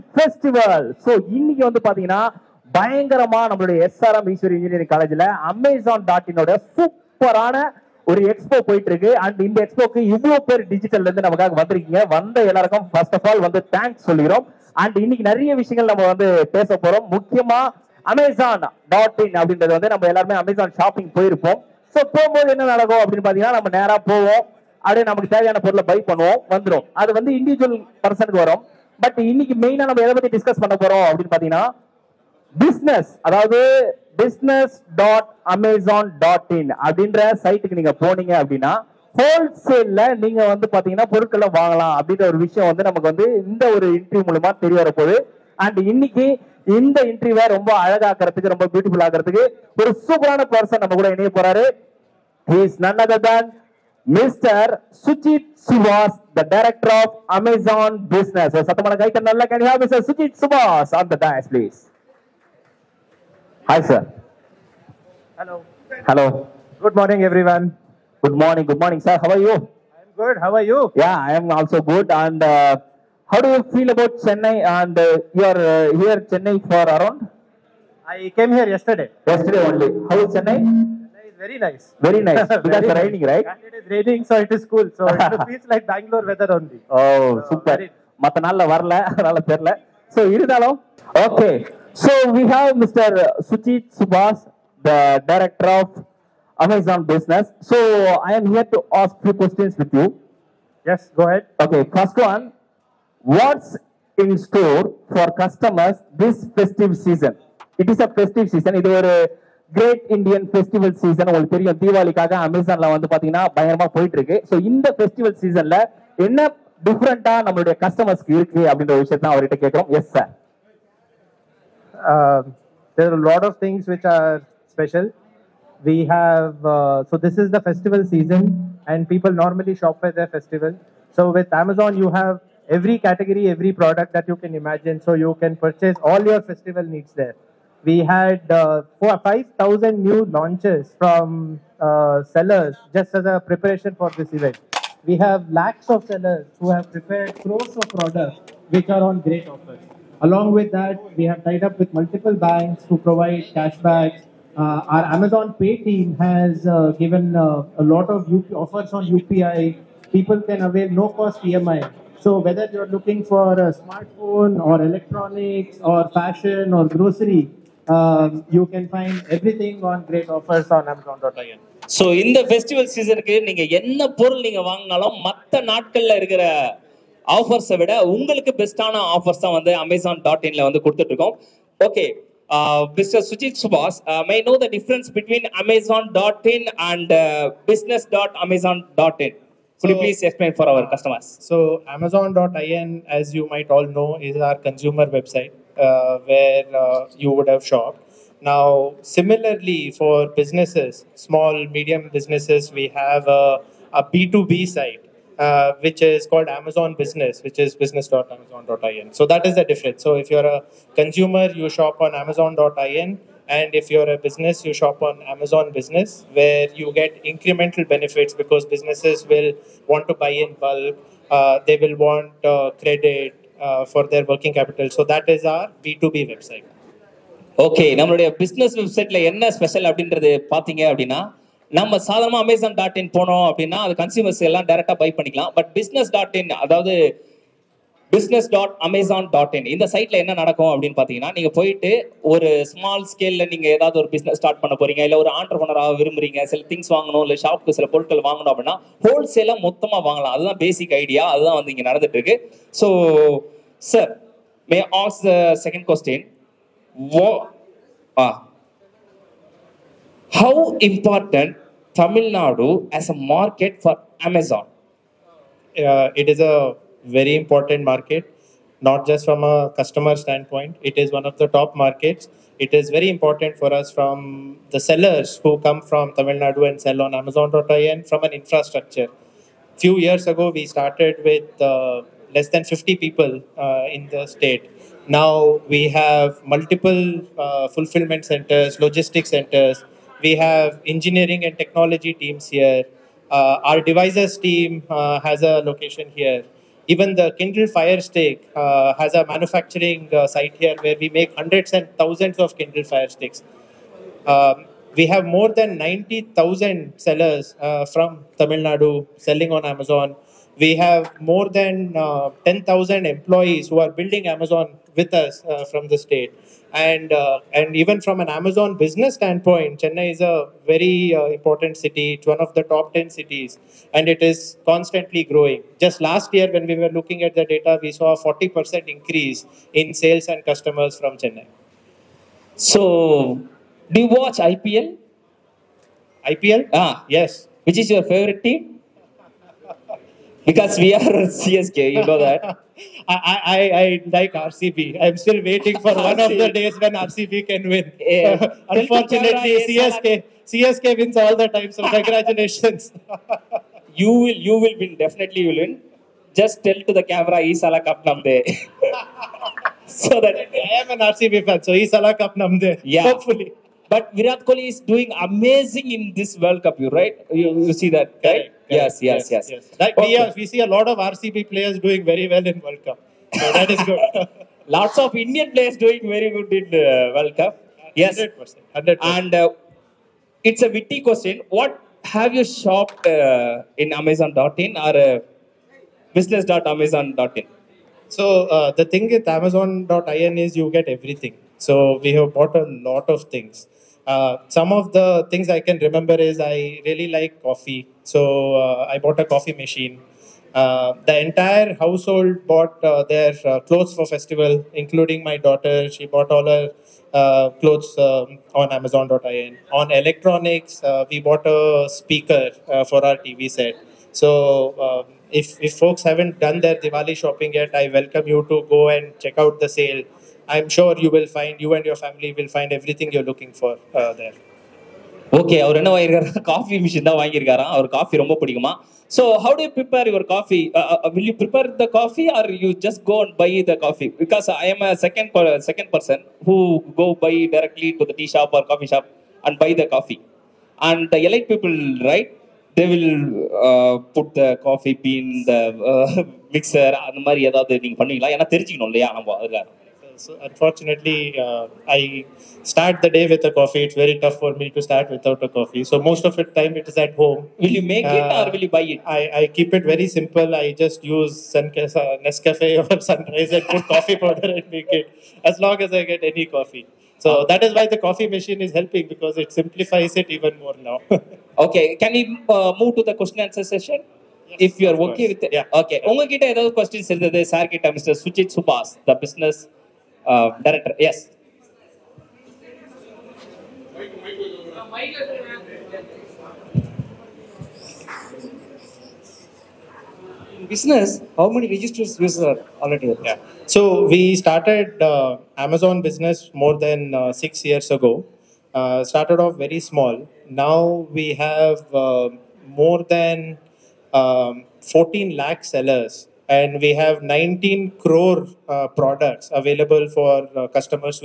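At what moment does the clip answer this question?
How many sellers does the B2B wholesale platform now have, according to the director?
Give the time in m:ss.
8:22.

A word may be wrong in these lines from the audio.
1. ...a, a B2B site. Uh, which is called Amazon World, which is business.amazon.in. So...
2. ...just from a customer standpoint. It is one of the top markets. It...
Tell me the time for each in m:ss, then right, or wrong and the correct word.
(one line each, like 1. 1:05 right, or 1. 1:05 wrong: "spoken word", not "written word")
1. 3:23 wrong: "Business", not "World"
2. 4:29 right.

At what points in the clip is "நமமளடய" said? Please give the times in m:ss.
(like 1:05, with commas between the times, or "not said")
0:03, 1:57, 3:47.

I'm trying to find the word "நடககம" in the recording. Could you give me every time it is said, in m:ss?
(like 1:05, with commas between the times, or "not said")
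0:22, 4:00.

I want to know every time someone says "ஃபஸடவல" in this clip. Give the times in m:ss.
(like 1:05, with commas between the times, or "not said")
1:50, 1:54, 2:52.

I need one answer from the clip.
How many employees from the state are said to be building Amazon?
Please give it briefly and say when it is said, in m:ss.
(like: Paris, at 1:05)
more than 10,000, at 5:11.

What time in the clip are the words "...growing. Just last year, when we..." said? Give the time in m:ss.
5:25.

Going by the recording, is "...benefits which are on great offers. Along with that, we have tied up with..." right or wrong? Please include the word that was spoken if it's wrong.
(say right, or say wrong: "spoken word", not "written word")
wrong: "products", not "benefits".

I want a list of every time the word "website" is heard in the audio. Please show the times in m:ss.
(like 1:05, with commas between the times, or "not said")
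3:15, 3:46.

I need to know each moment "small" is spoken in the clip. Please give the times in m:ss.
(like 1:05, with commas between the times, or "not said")
3:21, 8:19.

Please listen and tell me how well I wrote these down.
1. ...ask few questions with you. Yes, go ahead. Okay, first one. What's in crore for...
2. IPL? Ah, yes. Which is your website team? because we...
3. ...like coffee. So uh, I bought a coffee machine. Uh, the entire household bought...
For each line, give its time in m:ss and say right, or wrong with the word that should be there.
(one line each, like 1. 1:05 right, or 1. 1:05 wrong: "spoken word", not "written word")
1. 1:39 wrong: "store", not "crore"
2. 5:36 wrong: "favorite", not "website"
3. 6:37 right.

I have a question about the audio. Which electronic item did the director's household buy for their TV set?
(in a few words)
speaker.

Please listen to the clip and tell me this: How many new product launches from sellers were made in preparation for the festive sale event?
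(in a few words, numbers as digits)
5,000.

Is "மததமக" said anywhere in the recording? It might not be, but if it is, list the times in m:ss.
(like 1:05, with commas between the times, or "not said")
4:09.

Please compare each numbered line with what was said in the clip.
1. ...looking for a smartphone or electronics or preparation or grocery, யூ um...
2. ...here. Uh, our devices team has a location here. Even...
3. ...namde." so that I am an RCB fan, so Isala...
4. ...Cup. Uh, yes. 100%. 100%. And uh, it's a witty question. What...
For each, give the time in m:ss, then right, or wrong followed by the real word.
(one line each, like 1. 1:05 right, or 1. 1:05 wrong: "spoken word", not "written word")
1. 2:42 wrong: "fashion", not "preparation"
2. 4:52 right
3. 5:58 right
4. 6:17 right.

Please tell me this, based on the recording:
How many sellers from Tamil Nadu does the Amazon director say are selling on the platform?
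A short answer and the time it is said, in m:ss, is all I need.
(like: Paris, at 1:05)
more than 90,000, at 5:05.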